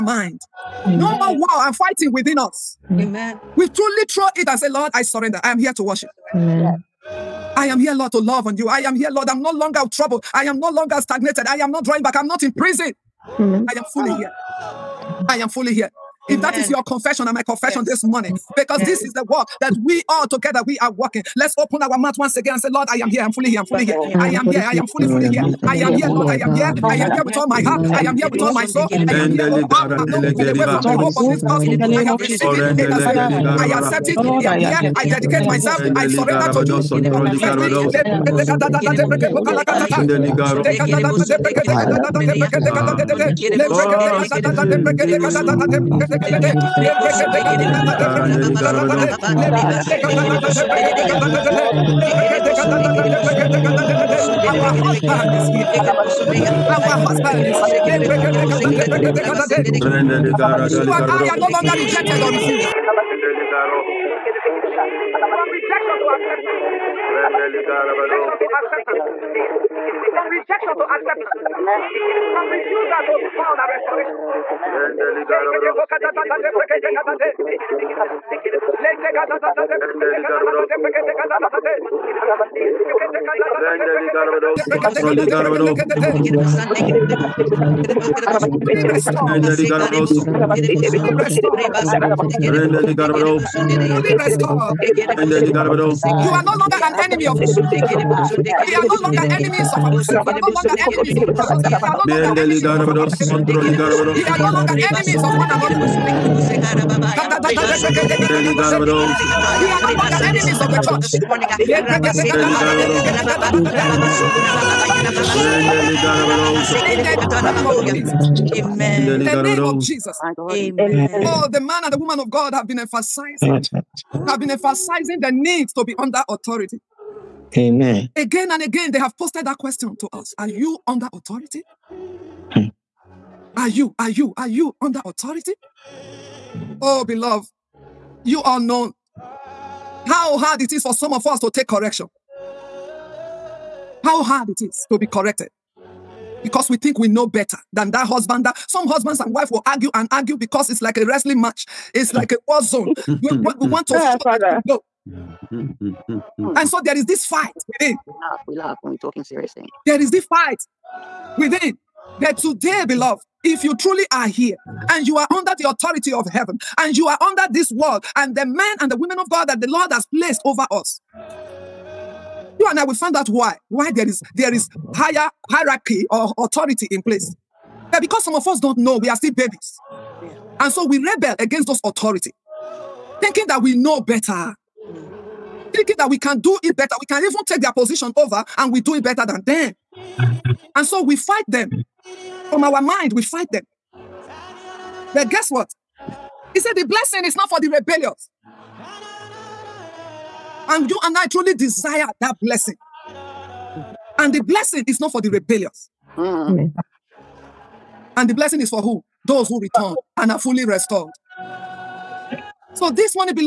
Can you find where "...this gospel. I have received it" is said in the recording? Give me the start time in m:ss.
0:31.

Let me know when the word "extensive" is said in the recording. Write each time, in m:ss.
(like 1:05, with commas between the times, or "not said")
not said.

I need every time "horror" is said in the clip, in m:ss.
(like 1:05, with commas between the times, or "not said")
not said.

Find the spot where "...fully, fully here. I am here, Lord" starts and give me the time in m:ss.
0:24.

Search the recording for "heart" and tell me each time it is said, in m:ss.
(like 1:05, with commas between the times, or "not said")
0:27.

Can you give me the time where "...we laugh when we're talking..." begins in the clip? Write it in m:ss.
2:38.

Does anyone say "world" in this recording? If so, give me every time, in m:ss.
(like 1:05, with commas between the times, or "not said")
2:47.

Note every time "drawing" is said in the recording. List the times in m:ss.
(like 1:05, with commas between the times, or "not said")
0:11.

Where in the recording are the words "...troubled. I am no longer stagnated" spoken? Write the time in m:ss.
0:09.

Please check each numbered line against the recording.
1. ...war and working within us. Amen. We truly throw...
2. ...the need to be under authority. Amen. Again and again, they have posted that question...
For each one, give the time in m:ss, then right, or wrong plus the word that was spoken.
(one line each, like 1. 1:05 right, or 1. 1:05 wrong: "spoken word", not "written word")
1. 0:01 wrong: "fighting", not "working"
2. 2:05 right.